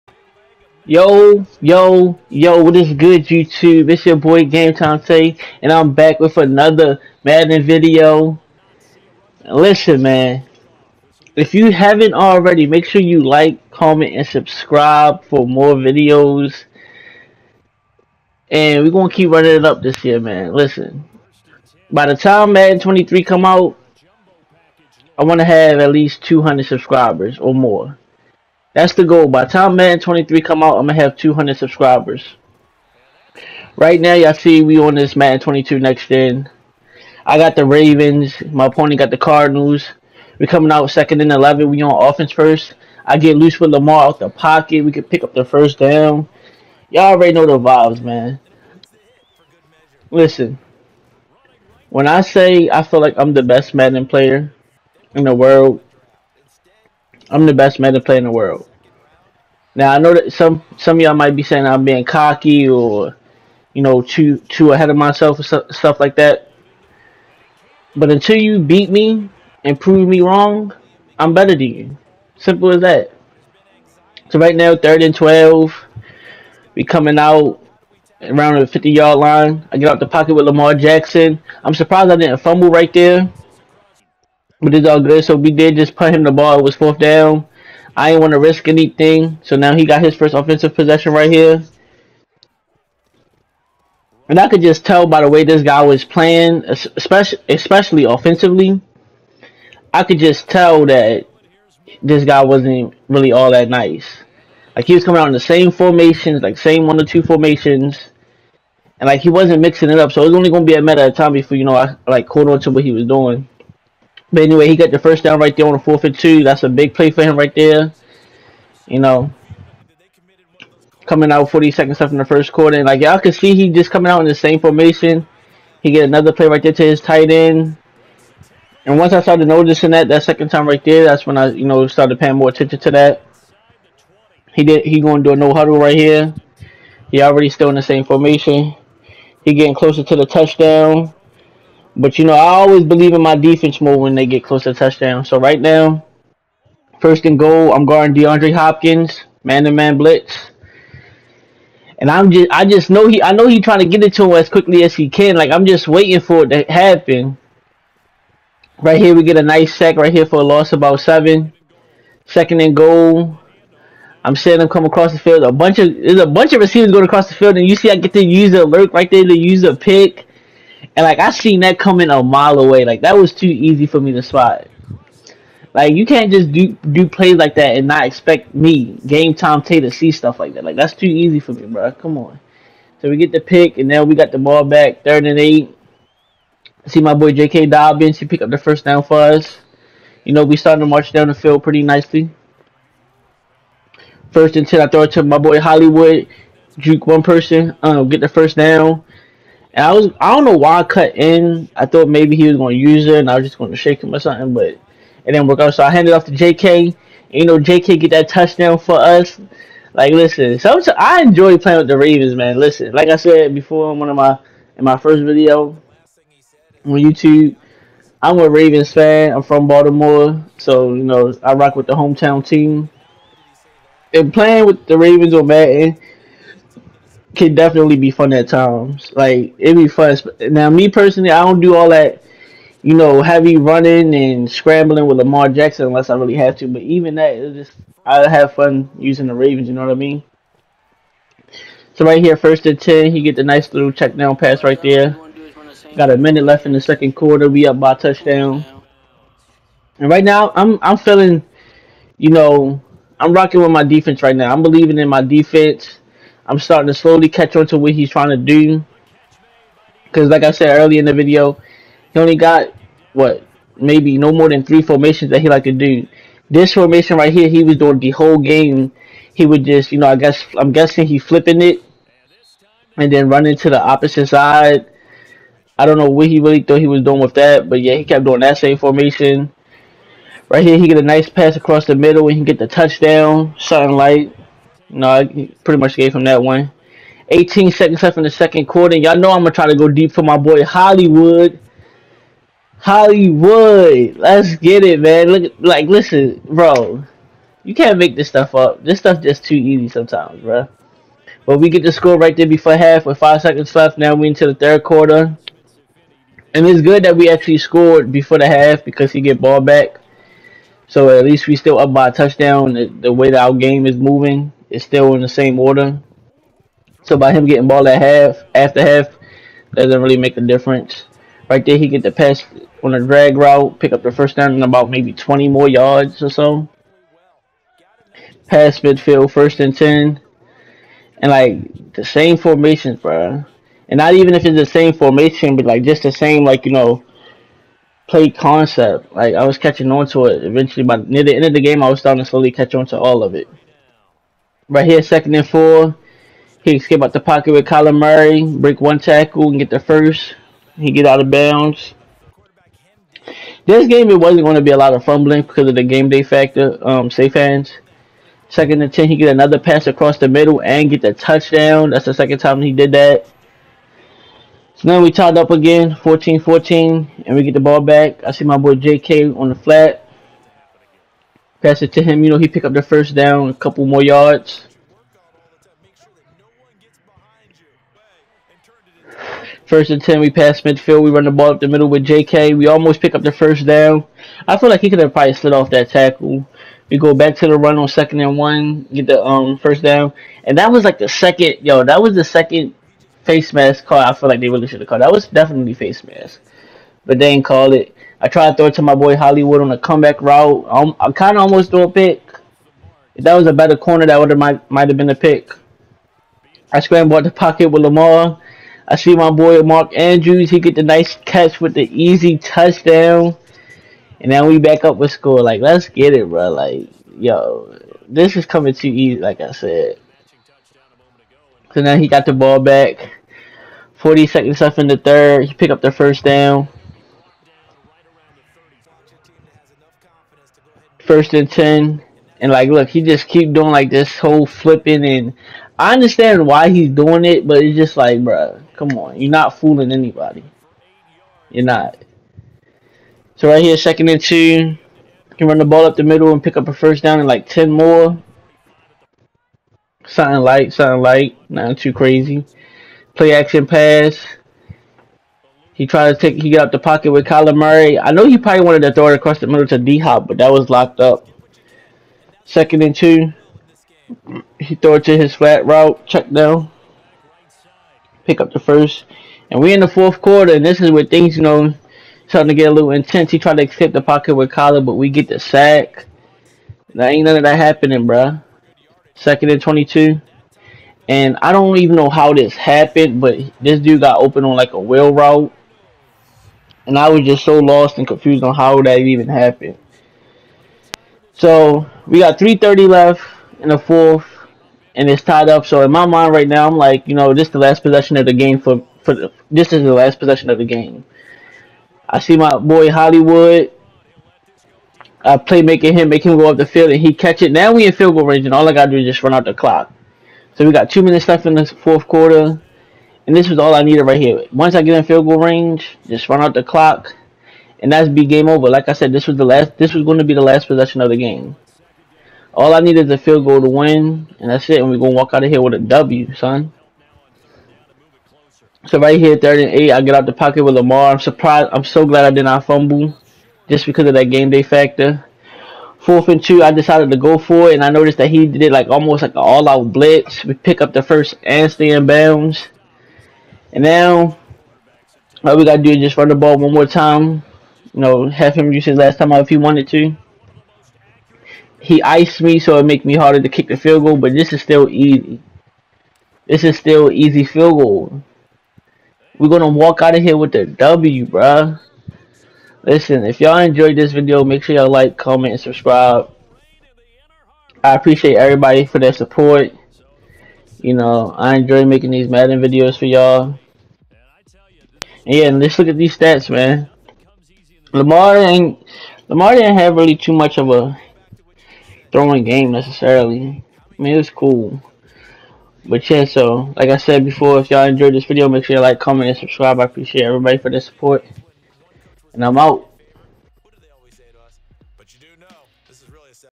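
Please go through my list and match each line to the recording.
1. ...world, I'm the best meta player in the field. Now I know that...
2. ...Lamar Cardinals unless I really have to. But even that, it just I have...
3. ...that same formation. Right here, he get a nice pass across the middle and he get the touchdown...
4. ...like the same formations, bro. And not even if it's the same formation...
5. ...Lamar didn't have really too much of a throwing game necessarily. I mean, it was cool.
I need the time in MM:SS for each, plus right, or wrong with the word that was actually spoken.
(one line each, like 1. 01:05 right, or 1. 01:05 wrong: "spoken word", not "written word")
1. 00:55 wrong: "world", not "field"
2. 03:55 wrong: "Jackson", not "Cardinals"
3. 04:38 right
4. 05:31 right
5. 09:39 right.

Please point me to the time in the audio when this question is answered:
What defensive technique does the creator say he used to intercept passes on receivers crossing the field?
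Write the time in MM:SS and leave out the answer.
02:48.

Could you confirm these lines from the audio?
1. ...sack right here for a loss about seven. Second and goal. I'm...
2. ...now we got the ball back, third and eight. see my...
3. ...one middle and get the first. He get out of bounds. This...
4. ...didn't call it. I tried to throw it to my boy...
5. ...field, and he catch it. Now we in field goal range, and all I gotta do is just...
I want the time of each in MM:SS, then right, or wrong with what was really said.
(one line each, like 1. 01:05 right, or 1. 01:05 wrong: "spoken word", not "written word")
1. 02:39 right
2. 03:03 right
3. 05:48 wrong: "tackle", not "middle"
4. 06:37 right
5. 08:26 right.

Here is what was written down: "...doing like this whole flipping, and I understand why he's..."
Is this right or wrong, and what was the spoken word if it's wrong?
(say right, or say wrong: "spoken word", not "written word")
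right.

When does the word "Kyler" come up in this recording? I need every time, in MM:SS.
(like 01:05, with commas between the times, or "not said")
05:47, 07:37, 07:54.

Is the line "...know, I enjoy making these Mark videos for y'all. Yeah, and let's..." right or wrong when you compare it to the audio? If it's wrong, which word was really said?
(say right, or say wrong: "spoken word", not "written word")
wrong: "Madden", not "Mark".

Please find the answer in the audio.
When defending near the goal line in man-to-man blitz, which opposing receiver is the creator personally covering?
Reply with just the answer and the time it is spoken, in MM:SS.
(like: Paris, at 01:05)
DeAndre Hopkins, at 02:28.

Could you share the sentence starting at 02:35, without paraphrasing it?
Like I'm just waiting for it to happen.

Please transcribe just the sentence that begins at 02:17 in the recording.
He already still in the same formation.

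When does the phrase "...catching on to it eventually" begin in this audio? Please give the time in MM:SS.
05:39.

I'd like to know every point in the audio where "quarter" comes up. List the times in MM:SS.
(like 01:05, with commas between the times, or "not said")
02:02, 04:07, 04:48, 05:04, 07:50, 08:32.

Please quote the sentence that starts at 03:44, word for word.
And playing with the Ravens on Madden, can definitely be fun at times.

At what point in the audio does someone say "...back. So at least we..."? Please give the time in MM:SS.
05:09.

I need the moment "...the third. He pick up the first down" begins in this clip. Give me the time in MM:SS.
07:04.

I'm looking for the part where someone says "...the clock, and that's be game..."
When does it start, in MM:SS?
08:36.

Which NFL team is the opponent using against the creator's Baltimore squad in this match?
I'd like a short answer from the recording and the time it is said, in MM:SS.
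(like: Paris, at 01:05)
Cardinals, at 00:39.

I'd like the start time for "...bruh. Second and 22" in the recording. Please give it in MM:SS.
07:58.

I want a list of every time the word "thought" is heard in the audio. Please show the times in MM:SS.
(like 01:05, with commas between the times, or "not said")
03:21, 04:36.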